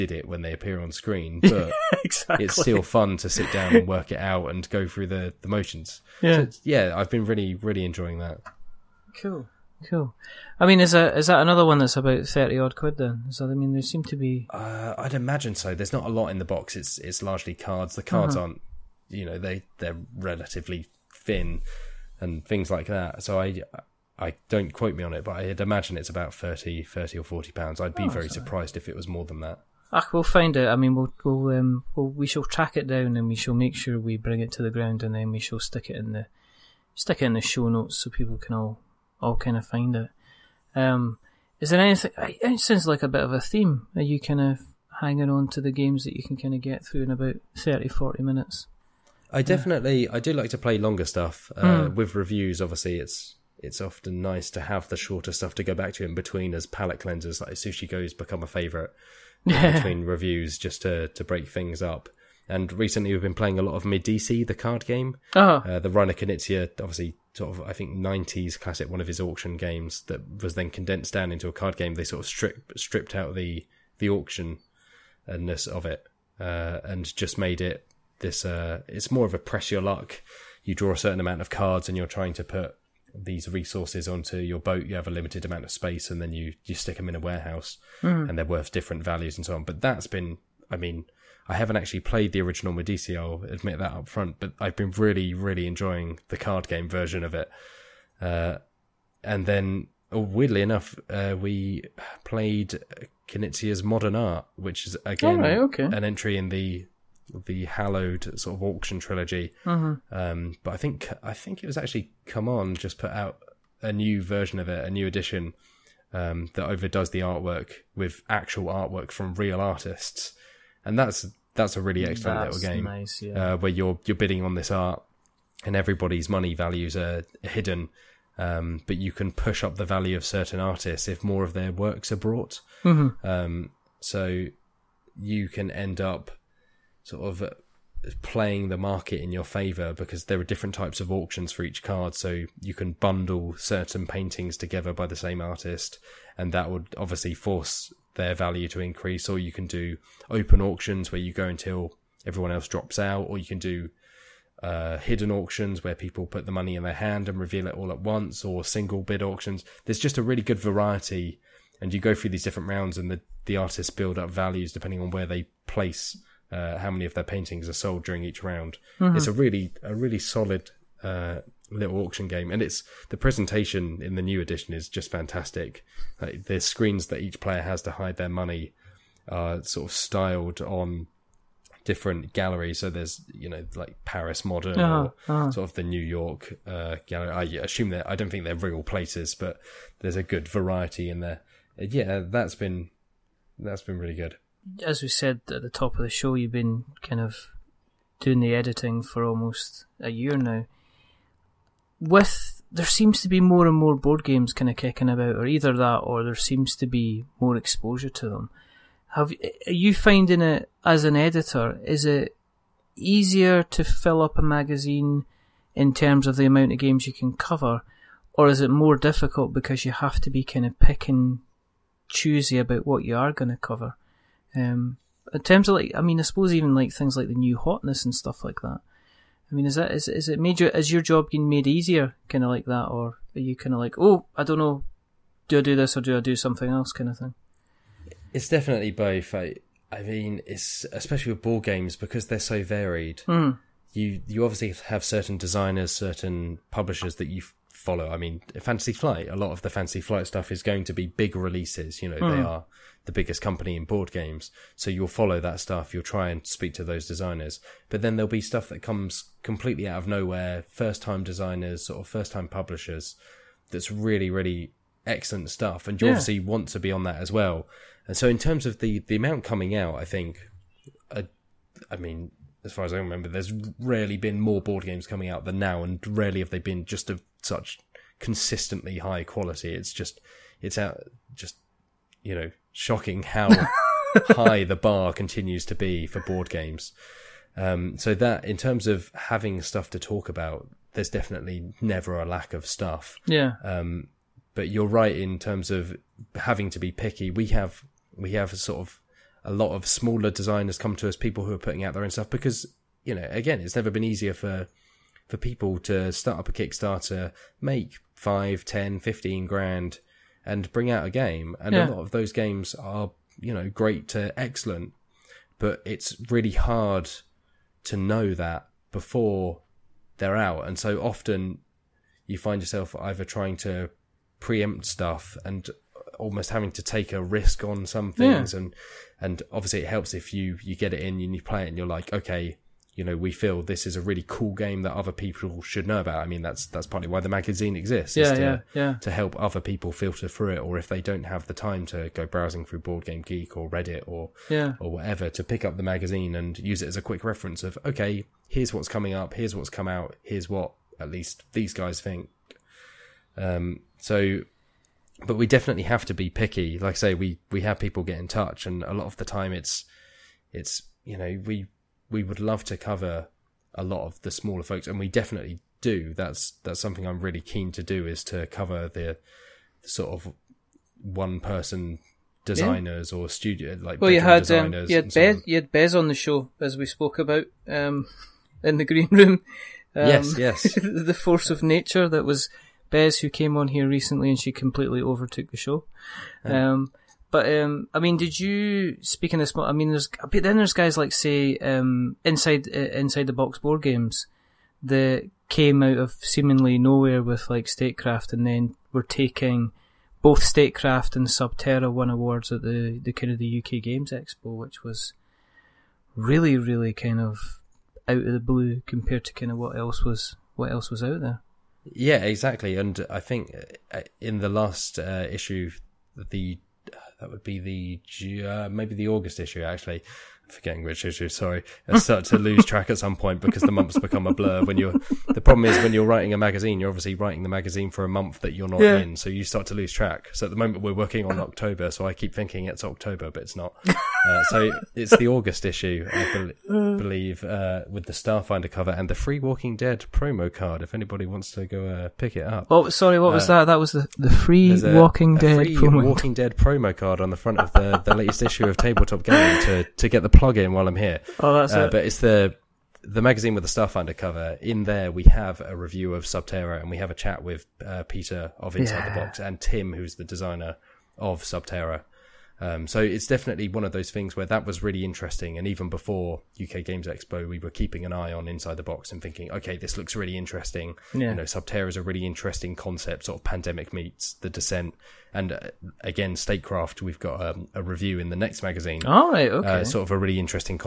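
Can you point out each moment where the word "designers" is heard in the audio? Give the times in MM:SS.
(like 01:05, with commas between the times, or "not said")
04:05, 04:17, 04:21, 05:00, 06:12, 07:40.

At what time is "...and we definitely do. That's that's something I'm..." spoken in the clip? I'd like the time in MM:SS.
06:04.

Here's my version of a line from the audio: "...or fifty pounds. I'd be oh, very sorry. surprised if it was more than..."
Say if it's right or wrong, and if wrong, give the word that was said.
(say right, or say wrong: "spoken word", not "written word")
wrong: "forty", not "fifty".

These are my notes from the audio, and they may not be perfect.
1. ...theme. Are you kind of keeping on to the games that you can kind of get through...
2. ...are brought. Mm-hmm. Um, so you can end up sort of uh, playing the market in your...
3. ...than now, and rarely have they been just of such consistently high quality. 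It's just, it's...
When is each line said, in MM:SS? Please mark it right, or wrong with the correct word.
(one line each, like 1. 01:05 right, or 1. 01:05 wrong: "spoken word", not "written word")
1. 00:43 wrong: "hanging", not "keeping"
2. 02:12 right
3. 04:35 right.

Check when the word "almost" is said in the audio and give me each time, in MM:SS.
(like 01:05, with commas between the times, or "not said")
03:19, 05:26.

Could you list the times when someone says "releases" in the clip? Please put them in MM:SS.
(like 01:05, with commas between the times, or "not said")
04:11.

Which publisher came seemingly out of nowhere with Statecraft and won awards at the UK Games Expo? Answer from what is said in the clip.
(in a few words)
Inside the Box Board Games.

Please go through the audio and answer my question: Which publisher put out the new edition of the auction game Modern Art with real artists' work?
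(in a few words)
CMON.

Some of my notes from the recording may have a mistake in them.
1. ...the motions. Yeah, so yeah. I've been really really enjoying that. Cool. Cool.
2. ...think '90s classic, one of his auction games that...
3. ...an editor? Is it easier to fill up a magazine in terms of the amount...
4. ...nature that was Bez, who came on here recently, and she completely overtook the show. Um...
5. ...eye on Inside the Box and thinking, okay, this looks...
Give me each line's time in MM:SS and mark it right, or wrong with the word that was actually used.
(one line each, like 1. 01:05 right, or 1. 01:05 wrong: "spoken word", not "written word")
1. 00:05 right
2. 01:07 right
3. 03:31 right
4. 06:21 right
5. 07:48 right.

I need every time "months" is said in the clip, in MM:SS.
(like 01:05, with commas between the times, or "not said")
07:03, 07:08.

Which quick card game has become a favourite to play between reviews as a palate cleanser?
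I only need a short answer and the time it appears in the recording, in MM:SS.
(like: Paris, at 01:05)
Sushi Go, at 00:57.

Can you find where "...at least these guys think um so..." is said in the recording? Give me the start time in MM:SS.
05:50.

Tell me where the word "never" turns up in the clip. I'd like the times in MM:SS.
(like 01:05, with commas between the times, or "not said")
04:51, 05:03.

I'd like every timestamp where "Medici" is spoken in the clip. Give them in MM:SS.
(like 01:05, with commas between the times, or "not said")
01:03, 01:32.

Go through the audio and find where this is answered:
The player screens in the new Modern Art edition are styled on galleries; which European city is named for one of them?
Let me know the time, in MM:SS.
03:04.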